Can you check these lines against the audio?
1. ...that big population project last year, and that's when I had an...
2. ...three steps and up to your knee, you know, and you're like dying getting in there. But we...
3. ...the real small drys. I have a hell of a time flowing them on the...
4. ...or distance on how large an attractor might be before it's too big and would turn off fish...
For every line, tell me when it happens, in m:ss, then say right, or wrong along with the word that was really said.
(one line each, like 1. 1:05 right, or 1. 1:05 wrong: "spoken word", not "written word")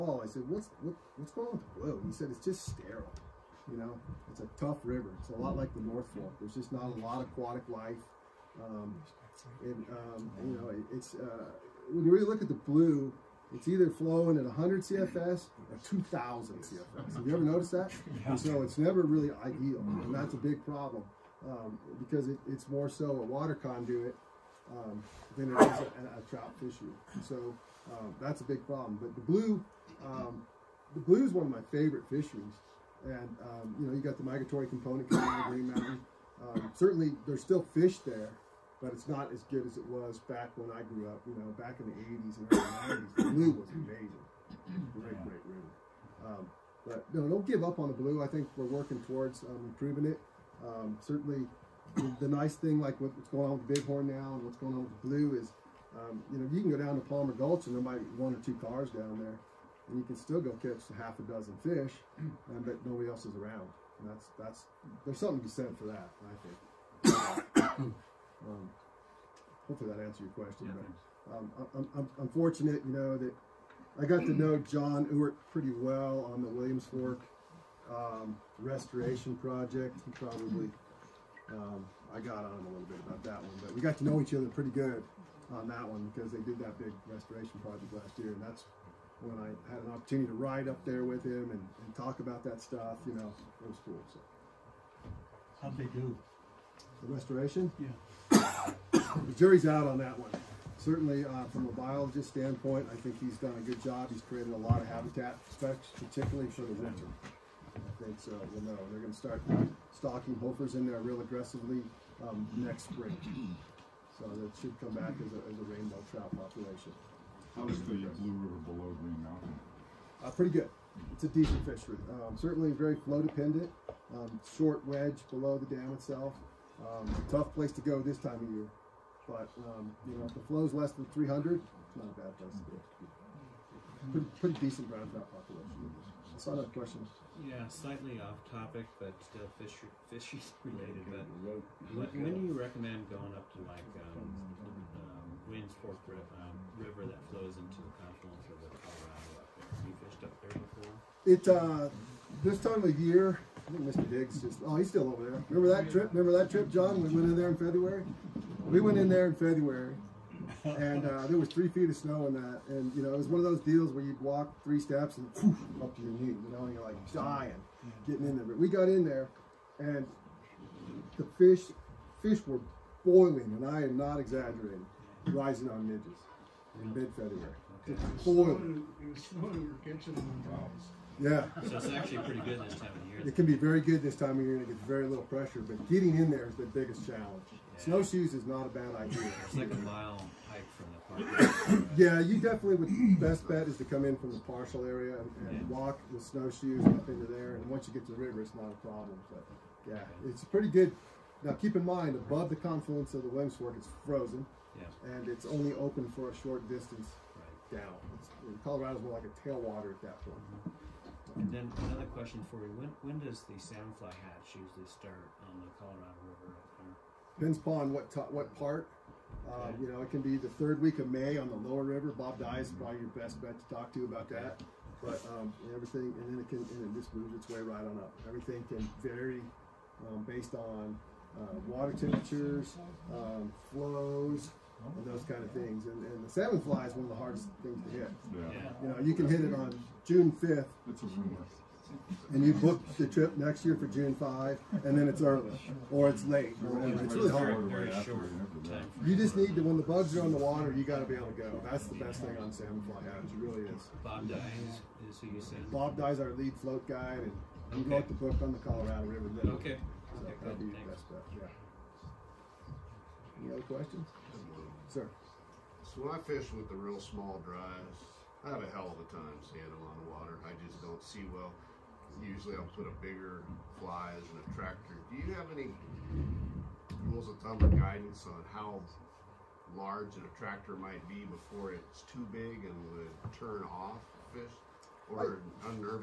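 1. 1:26 wrong: "restoration", not "population"
2. 2:44 right
3. 4:26 wrong: "seeing", not "flowing"
4. 4:37 wrong: "guidance", not "distance".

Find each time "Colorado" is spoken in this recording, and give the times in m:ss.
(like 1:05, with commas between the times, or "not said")
2:28, 3:28, 3:35, 4:18.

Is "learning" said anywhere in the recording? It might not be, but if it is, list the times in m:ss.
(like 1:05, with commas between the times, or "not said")
not said.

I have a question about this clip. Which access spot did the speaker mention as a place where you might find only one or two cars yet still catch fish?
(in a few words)
Palmer Gulch.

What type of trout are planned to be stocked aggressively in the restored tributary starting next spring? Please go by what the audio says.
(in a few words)
Hofer's.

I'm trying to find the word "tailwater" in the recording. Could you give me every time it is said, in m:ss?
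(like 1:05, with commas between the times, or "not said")
3:29.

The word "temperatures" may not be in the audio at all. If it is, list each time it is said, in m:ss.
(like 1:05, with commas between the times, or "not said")
3:51.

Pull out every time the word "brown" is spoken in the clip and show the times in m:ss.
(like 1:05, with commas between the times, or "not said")
2:14.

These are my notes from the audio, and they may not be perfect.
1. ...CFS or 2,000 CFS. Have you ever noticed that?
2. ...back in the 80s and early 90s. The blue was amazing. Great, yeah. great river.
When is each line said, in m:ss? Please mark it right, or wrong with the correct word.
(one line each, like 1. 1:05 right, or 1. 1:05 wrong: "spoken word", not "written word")
1. 0:14 right
2. 0:41 right.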